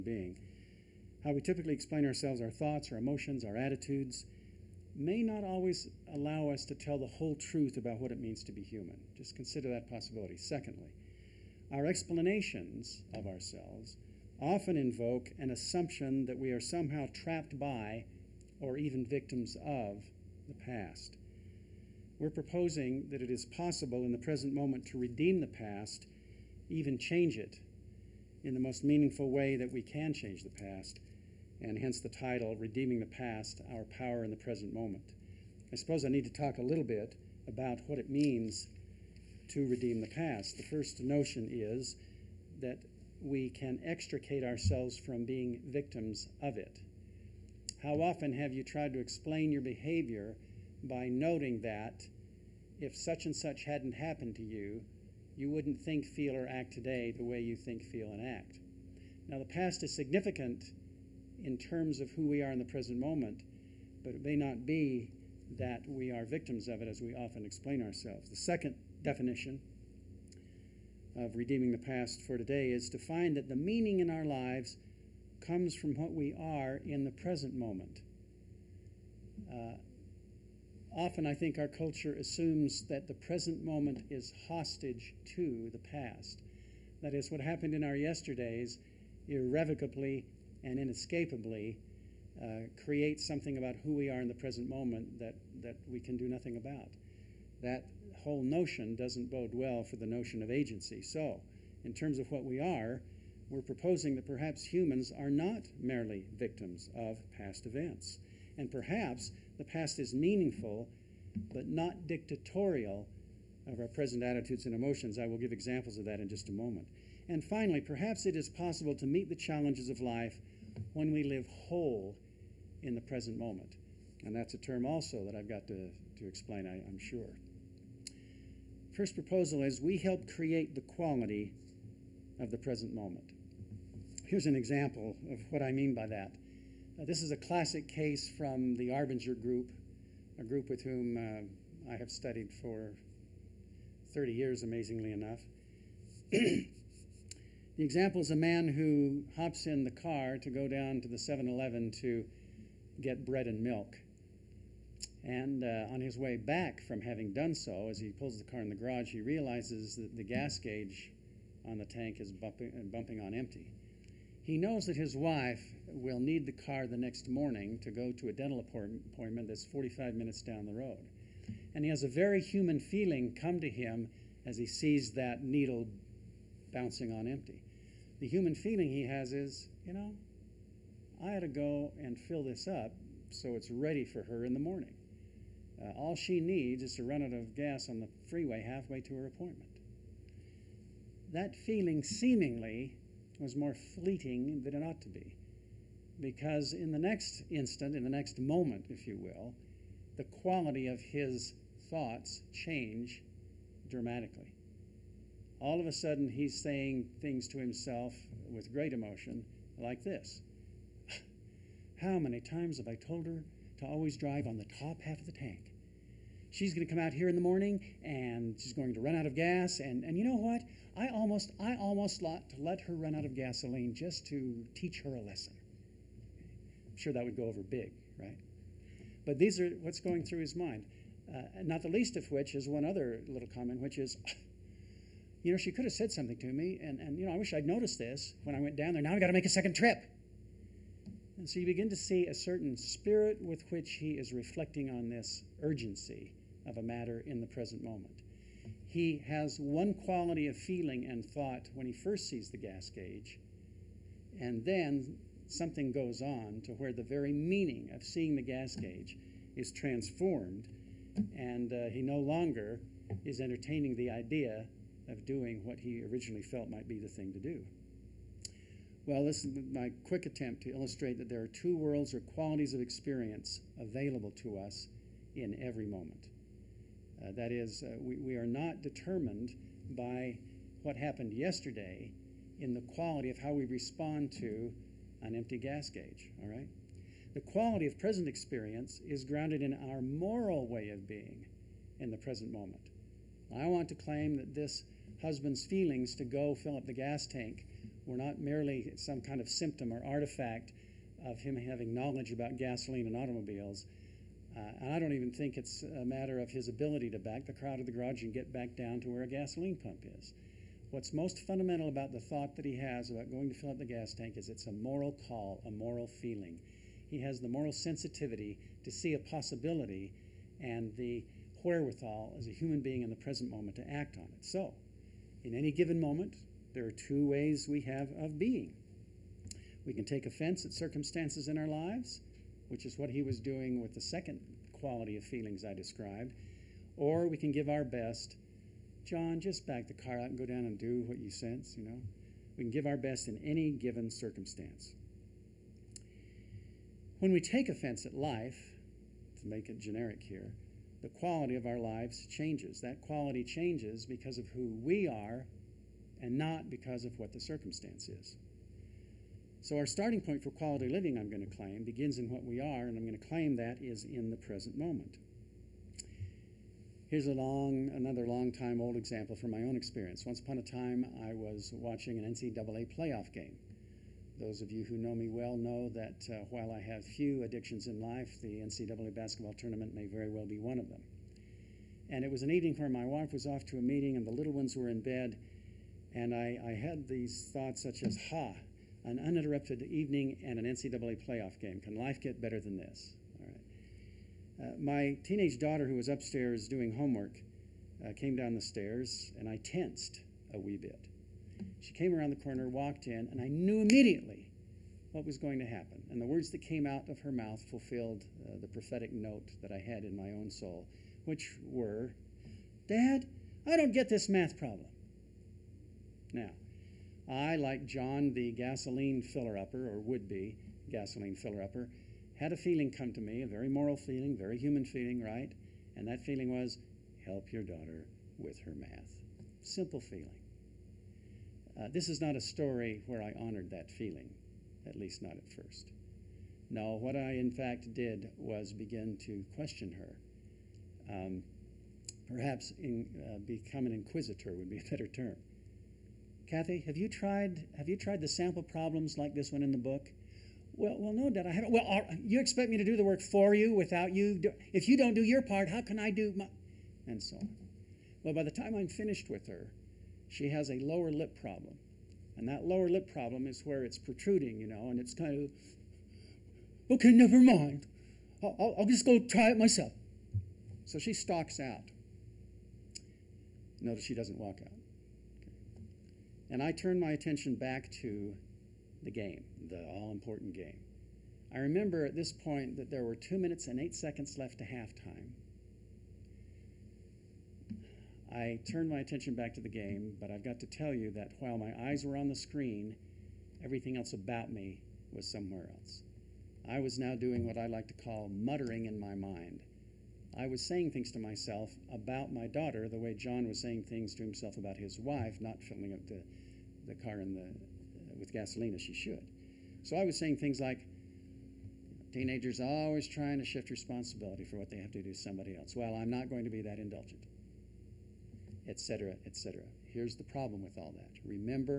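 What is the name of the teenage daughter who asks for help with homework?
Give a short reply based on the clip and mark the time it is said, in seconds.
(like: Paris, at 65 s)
Kathy, at 446 s.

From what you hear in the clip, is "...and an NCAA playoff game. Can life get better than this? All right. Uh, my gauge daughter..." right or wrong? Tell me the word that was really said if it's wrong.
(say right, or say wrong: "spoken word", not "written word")
wrong: "teenage", not "gauge".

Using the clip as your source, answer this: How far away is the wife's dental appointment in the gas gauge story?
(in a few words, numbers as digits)
45 minutes.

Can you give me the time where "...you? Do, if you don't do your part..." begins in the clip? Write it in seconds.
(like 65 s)
454 s.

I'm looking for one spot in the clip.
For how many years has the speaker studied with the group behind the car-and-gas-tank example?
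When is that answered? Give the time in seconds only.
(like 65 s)
144 s.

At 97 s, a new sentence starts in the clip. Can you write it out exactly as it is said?
That whole notion doesn't bode well for the notion of agency.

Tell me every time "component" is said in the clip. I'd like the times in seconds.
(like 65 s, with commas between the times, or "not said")
not said.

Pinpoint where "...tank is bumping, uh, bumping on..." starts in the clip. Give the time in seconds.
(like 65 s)
161 s.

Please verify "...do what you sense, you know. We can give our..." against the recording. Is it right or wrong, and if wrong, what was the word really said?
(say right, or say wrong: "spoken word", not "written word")
right.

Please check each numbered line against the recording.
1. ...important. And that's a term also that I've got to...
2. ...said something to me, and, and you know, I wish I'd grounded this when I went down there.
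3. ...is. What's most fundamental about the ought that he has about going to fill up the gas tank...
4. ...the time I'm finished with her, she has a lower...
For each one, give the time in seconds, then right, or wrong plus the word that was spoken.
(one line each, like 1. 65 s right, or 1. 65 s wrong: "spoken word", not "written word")
1. 123 s wrong: "moment", not "important"
2. 235 s wrong: "noticed", not "grounded"
3. 310 s wrong: "thought", not "ought"
4. 458 s right.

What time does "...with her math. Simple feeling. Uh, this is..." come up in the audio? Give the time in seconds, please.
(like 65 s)
428 s.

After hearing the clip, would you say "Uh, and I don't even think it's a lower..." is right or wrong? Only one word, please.
wrong.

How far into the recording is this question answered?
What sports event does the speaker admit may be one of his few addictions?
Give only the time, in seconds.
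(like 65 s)
378 s.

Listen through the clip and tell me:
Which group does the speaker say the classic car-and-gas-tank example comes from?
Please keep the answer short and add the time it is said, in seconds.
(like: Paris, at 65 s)
Arbinger group, at 138 s.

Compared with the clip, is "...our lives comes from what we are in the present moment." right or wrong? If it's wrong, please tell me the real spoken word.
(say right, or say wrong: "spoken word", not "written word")
right.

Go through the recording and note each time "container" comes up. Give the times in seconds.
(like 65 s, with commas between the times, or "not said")
not said.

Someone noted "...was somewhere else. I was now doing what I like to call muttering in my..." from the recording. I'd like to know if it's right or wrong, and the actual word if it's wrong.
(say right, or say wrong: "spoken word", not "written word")
right.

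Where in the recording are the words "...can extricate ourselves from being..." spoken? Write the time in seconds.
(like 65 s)
43 s.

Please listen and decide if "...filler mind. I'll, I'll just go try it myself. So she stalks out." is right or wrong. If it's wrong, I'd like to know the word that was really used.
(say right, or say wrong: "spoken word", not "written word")
wrong: "never", not "filler".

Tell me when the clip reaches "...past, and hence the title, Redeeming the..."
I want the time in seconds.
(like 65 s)
30 s.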